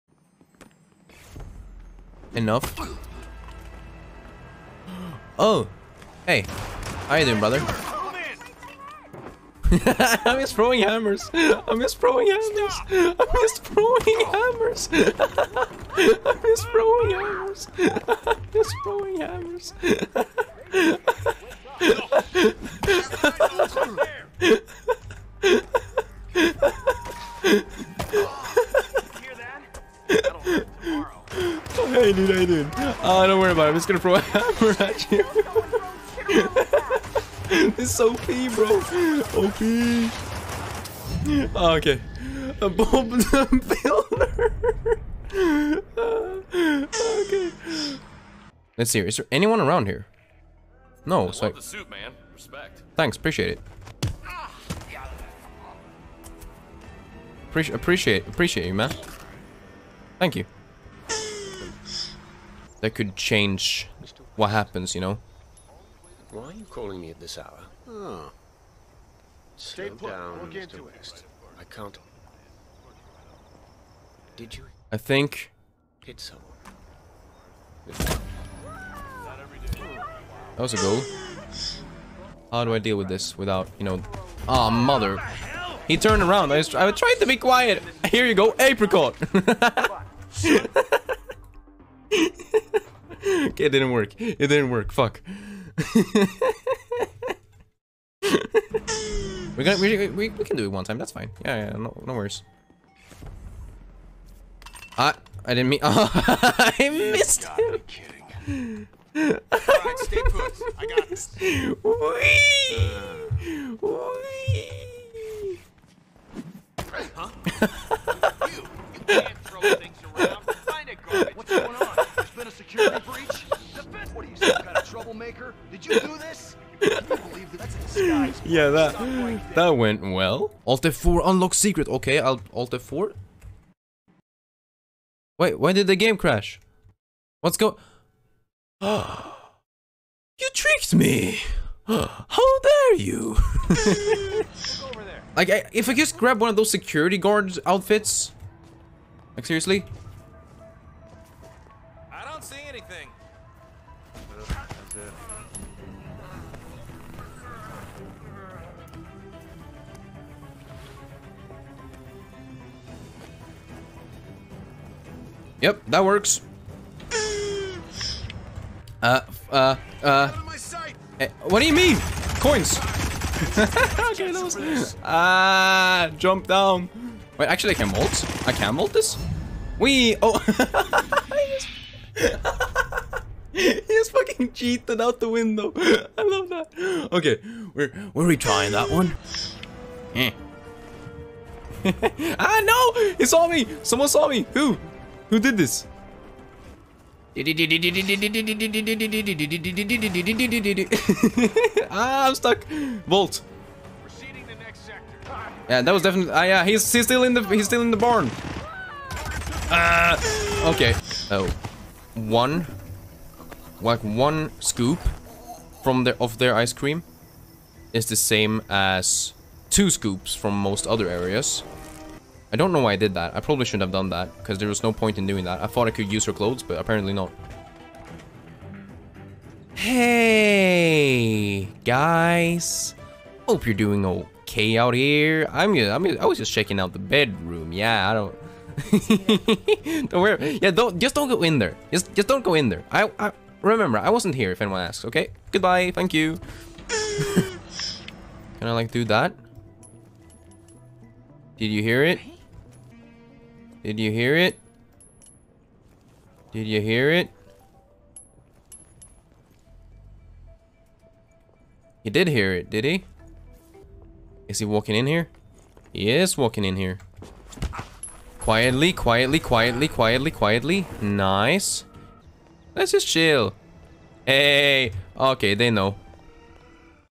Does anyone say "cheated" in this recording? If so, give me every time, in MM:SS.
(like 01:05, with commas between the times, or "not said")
03:04.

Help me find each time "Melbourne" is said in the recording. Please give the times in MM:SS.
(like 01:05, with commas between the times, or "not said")
not said.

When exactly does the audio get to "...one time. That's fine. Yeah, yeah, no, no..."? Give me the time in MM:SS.
01:40.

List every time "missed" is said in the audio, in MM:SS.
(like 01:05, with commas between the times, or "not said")
01:46.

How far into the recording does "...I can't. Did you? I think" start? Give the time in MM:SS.
01:11.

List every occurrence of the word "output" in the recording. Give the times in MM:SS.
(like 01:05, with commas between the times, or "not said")
not said.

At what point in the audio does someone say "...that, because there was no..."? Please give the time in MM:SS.
03:44.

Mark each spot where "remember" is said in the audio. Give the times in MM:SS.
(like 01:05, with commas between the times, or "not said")
04:03.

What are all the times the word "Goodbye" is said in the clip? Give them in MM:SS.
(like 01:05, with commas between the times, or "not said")
04:05.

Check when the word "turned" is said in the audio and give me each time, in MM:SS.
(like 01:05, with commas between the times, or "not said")
01:25.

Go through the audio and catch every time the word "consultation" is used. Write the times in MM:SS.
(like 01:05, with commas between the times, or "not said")
not said.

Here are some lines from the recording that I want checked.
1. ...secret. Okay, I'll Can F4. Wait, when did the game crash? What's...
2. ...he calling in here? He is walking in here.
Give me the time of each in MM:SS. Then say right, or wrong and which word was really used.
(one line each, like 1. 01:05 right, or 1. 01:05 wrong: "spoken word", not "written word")
1. 02:11 wrong: "Alt", not "Can"
2. 04:24 wrong: "walking", not "calling".